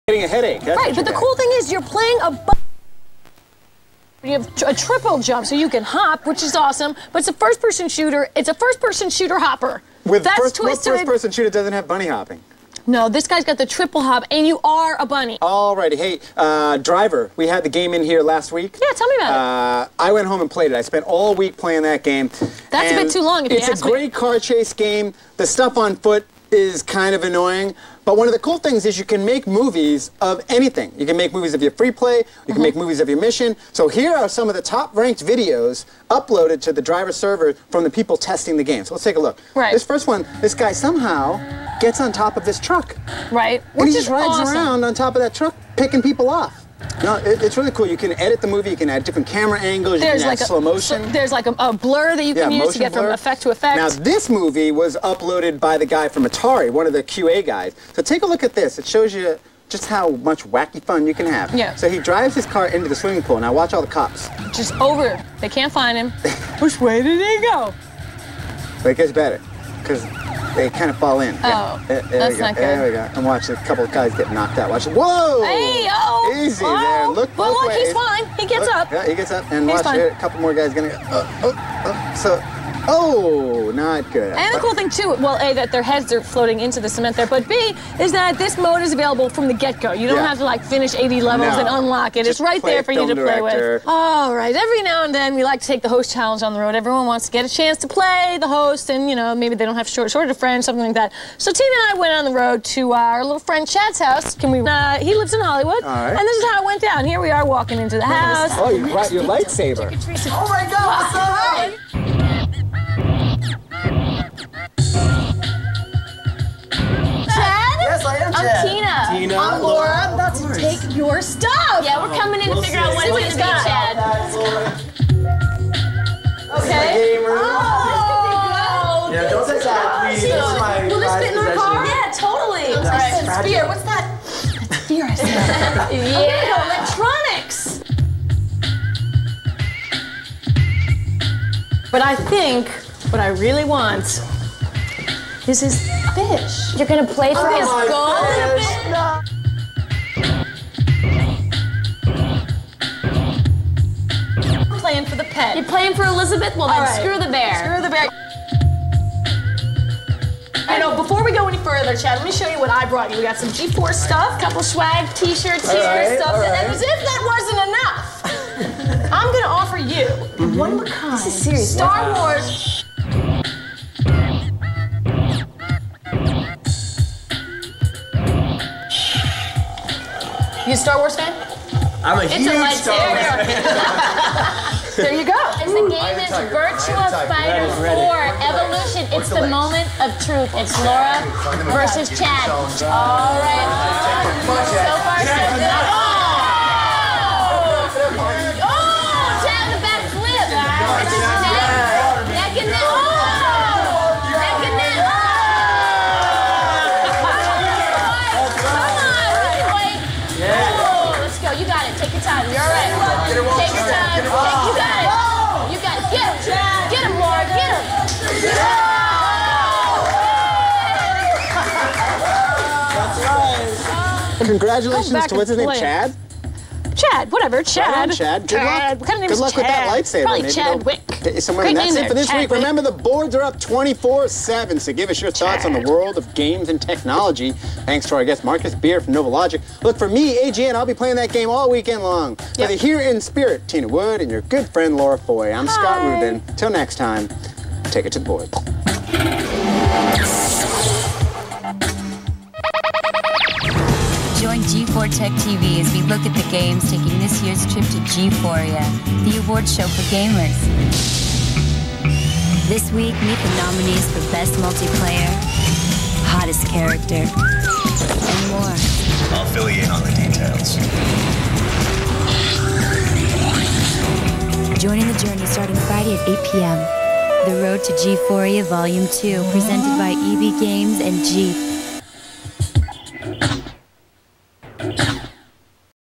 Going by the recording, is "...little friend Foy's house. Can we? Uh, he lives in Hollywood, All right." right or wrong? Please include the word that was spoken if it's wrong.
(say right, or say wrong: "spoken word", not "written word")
wrong: "Chad", not "Foy".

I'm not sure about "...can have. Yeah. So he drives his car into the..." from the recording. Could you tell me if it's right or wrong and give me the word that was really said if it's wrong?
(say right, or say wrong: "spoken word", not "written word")
right.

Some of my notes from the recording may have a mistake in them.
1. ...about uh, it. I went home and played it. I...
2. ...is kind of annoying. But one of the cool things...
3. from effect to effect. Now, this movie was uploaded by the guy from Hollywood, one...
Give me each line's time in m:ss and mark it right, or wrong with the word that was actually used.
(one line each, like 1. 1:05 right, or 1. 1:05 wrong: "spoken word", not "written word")
1. 0:19 right
2. 0:26 right
3. 0:53 wrong: "Atari", not "Hollywood".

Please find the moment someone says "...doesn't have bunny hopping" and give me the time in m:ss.
0:11.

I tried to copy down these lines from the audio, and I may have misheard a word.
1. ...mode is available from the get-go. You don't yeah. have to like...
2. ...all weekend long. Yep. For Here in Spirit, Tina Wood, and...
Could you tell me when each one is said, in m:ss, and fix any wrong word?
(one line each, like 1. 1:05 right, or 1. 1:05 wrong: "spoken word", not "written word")
1. 1:28 right
2. 4:01 right.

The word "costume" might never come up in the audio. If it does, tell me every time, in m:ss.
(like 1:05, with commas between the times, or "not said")
not said.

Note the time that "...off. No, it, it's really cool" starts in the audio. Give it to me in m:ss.
0:46.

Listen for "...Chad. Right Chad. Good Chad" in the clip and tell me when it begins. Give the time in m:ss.
3:47.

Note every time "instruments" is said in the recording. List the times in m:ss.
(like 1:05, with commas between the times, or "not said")
not said.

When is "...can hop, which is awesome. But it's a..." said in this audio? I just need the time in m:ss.
0:05.